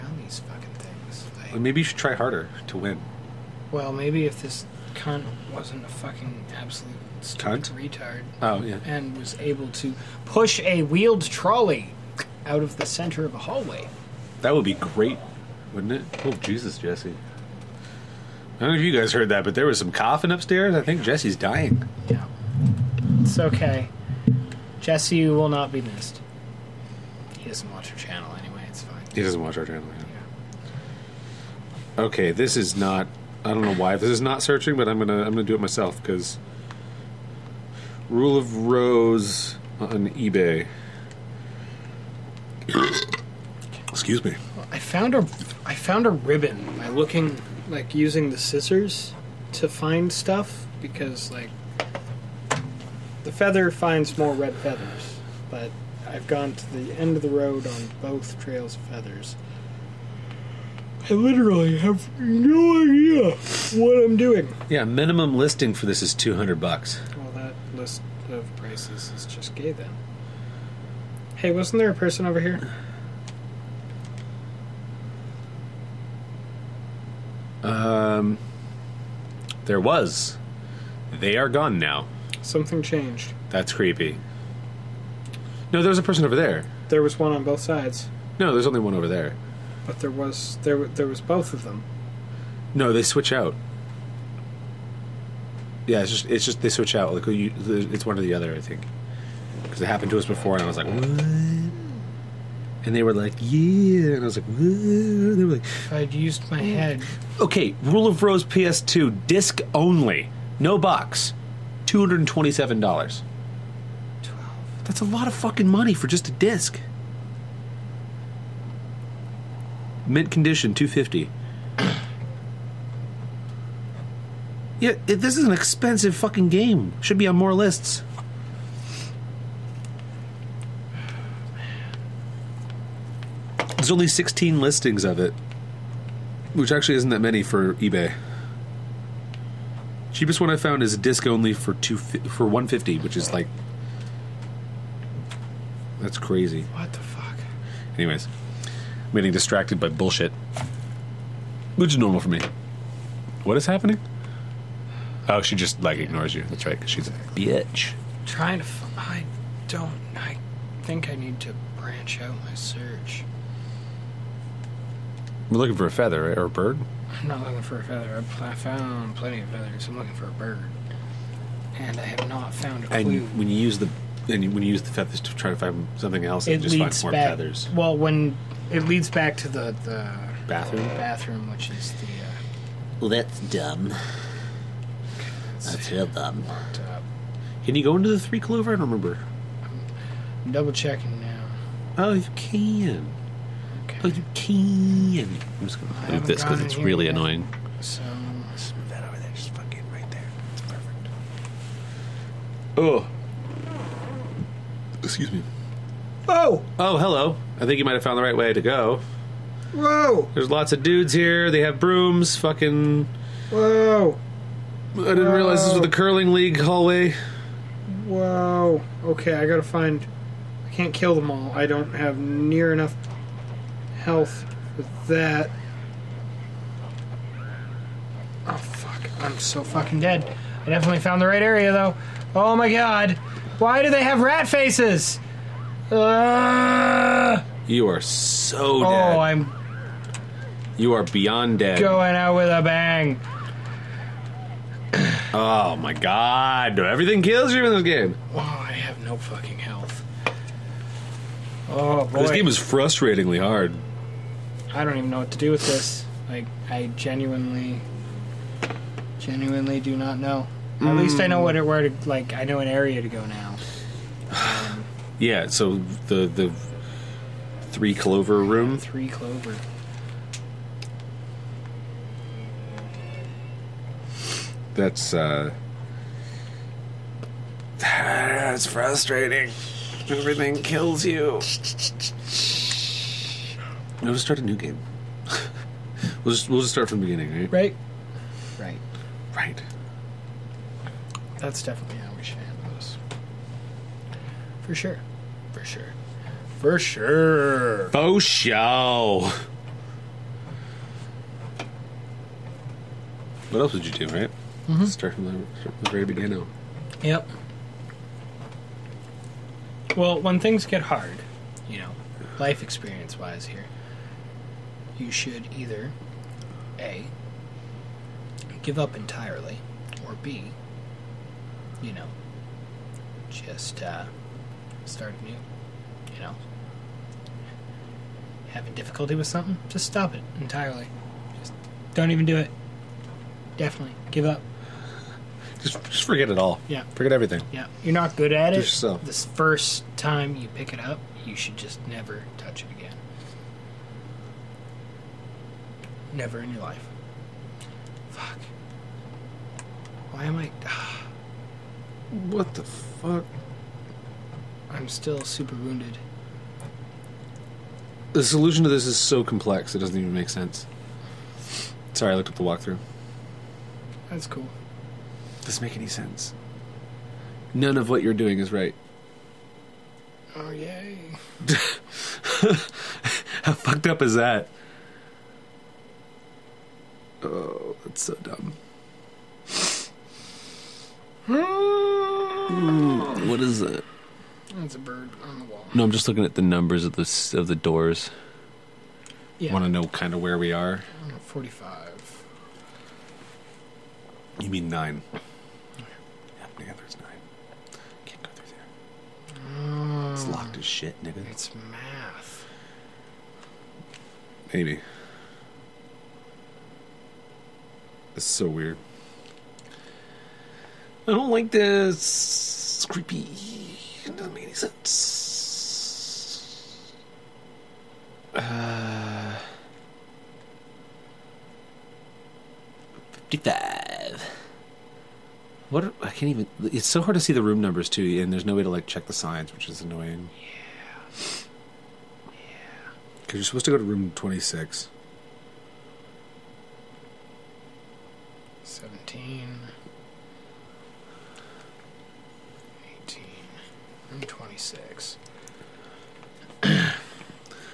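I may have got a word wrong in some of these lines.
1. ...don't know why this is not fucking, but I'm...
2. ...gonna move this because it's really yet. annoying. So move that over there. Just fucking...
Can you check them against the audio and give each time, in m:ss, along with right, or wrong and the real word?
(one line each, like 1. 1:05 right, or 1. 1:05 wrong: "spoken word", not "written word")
1. 0:33 wrong: "searching", not "fucking"
2. 3:15 right.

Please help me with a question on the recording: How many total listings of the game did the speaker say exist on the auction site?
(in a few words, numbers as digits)
16.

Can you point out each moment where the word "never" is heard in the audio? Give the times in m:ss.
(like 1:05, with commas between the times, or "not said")
5:41, 5:46.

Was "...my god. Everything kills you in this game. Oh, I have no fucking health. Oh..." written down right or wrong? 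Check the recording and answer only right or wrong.
right.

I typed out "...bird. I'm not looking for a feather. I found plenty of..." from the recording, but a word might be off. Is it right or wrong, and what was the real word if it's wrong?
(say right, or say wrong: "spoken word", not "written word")
right.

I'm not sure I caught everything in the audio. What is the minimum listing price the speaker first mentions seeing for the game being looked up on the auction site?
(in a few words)
$200.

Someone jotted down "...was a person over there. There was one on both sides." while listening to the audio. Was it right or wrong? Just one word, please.
right.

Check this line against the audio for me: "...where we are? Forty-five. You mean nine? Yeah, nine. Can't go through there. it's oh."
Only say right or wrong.
right.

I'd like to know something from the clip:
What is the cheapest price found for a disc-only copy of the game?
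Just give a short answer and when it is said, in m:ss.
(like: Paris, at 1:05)
$150, at 2:22.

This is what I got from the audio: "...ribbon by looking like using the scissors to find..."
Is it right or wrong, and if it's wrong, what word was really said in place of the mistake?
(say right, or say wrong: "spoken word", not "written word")
right.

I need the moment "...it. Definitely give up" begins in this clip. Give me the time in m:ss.
5:32.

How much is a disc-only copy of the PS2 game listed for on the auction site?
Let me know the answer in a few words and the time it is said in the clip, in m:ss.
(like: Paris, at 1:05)
$227, at 1:51.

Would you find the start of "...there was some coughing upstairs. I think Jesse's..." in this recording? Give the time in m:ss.
0:19.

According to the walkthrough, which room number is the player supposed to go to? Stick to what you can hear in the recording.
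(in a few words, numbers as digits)
26.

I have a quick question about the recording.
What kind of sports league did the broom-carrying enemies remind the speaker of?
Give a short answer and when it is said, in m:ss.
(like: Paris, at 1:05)
curling league, at 3:35.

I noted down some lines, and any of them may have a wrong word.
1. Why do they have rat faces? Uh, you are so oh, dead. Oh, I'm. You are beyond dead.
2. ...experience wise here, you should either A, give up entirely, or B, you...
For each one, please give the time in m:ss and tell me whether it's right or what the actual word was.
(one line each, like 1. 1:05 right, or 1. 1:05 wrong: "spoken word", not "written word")
1. 3:53 right
2. 5:12 right.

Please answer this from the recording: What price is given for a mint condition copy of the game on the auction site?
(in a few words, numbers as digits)
$250.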